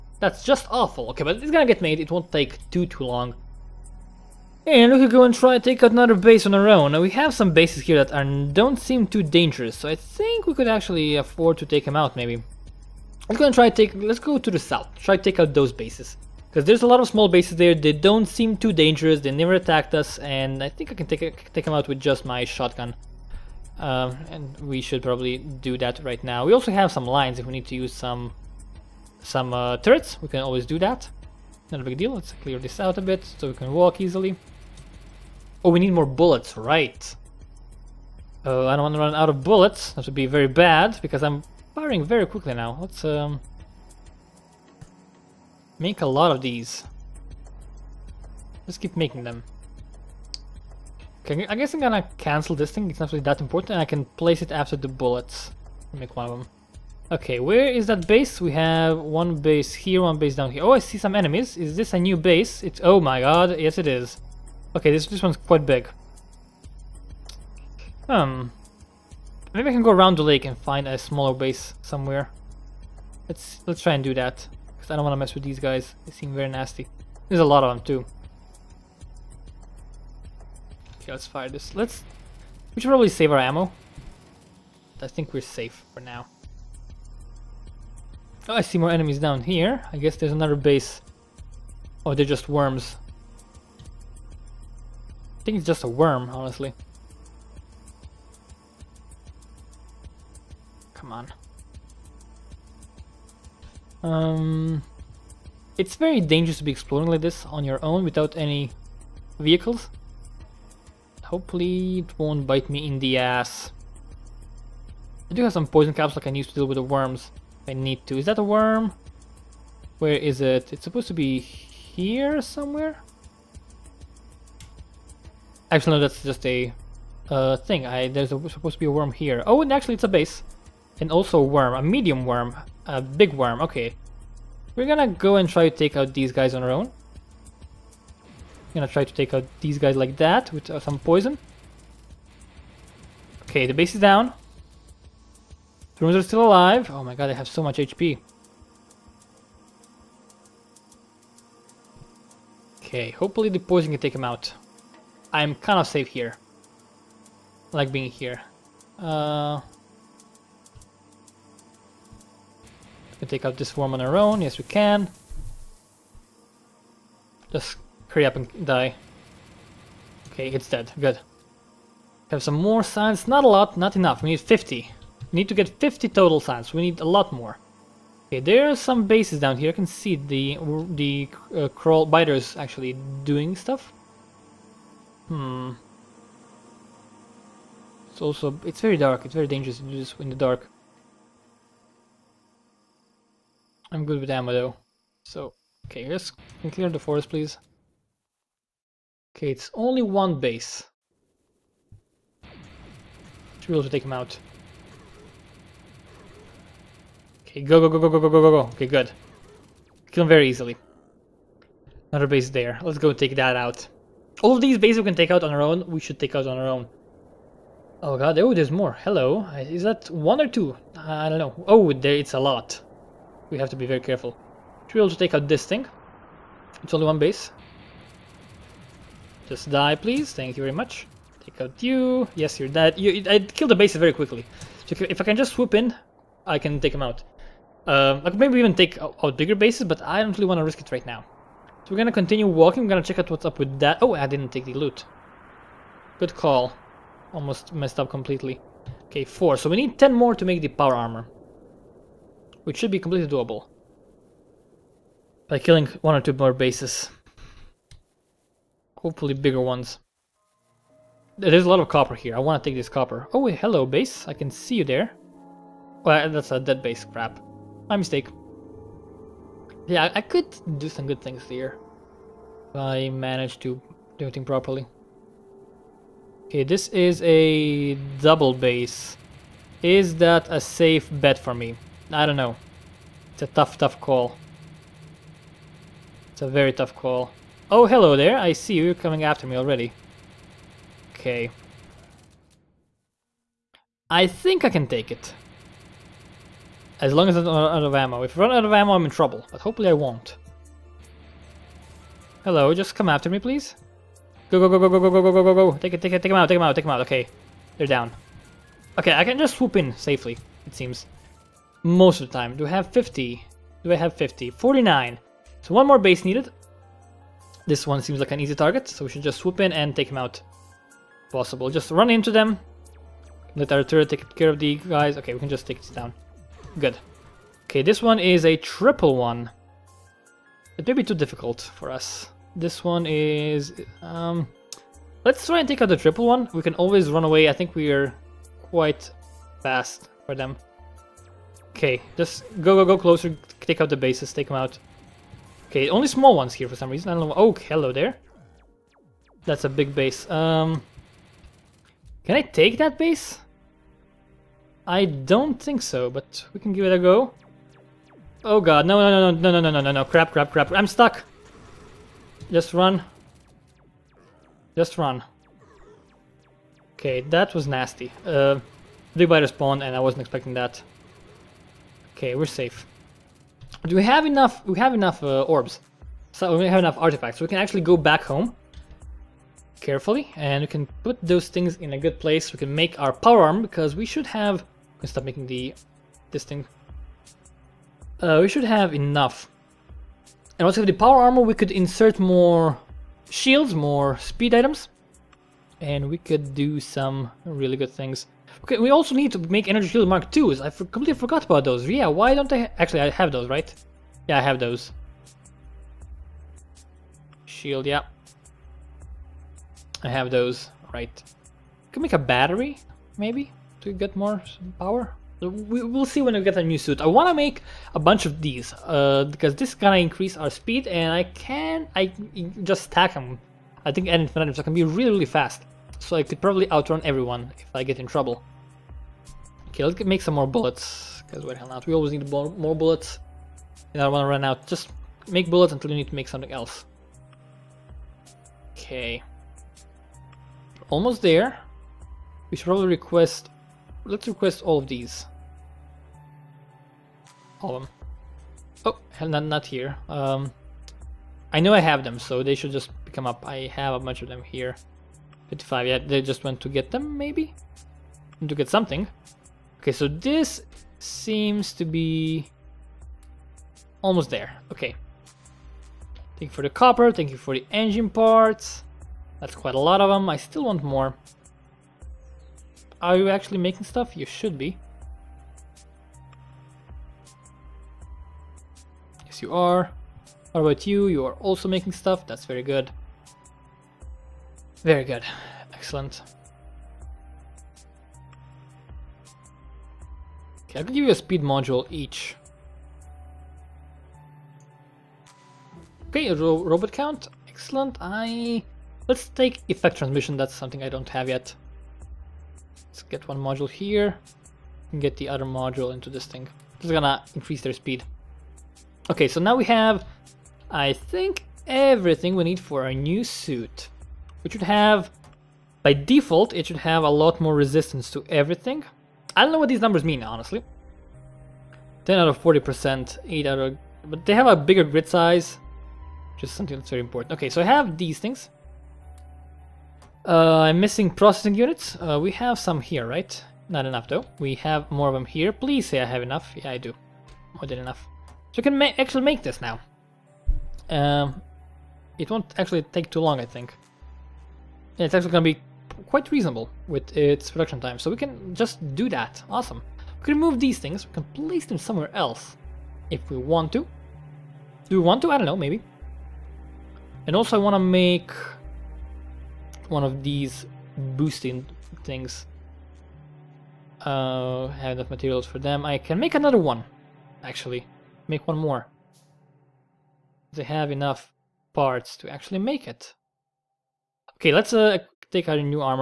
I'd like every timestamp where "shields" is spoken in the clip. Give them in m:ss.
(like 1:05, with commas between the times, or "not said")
6:33, 6:39, 6:47.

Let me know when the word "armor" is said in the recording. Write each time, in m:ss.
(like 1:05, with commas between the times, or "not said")
4:10, 6:31.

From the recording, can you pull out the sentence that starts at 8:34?
Which should have, by default, it should have a lot more resistance to everything.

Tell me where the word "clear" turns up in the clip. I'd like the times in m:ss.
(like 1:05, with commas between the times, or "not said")
0:32, 3:16.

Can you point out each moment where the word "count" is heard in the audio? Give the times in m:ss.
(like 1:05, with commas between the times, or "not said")
8:16.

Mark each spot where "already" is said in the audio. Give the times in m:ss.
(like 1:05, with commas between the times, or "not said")
4:49.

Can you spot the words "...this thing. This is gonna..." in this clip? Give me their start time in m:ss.
8:26.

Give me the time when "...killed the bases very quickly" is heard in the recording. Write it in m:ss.
3:53.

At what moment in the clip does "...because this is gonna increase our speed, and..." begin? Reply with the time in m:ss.
6:59.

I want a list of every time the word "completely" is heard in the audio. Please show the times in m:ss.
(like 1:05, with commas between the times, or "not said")
4:08, 4:12, 6:40.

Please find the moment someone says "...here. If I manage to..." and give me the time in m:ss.
4:31.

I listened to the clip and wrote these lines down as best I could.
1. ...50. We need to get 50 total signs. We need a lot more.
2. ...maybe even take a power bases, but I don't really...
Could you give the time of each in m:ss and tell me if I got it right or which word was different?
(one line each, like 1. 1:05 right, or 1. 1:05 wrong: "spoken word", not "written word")
1. 2:54 right
2. 3:58 wrong: "bigger", not "power".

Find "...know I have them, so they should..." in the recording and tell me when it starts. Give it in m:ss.
7:31.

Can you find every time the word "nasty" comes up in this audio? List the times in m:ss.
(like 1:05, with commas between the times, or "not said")
1:16, 6:07.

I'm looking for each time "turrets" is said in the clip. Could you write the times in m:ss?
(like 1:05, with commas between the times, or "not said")
0:29, 5:23.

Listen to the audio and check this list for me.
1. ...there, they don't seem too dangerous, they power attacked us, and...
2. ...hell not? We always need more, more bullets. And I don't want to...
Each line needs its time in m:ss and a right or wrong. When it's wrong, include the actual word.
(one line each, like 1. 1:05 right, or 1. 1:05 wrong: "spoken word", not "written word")
1. 0:17 wrong: "never", not "power"
2. 7:11 right.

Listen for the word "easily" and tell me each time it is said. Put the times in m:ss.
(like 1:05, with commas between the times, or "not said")
0:34, 3:30.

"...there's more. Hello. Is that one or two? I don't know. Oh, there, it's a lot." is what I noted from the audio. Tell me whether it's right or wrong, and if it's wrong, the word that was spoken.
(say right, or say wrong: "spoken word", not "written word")
right.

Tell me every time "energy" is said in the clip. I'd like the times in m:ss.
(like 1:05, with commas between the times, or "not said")
6:39.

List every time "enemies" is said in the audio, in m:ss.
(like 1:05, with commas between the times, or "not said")
1:01, 1:28.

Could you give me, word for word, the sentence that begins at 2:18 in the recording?
We're gonna try to take out these guys like that with uh, some poison.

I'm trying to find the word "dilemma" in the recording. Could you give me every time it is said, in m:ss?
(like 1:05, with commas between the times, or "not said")
not said.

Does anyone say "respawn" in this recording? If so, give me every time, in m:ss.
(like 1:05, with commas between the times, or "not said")
6:09.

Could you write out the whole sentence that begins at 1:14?
Because I don't want to mess with these guys.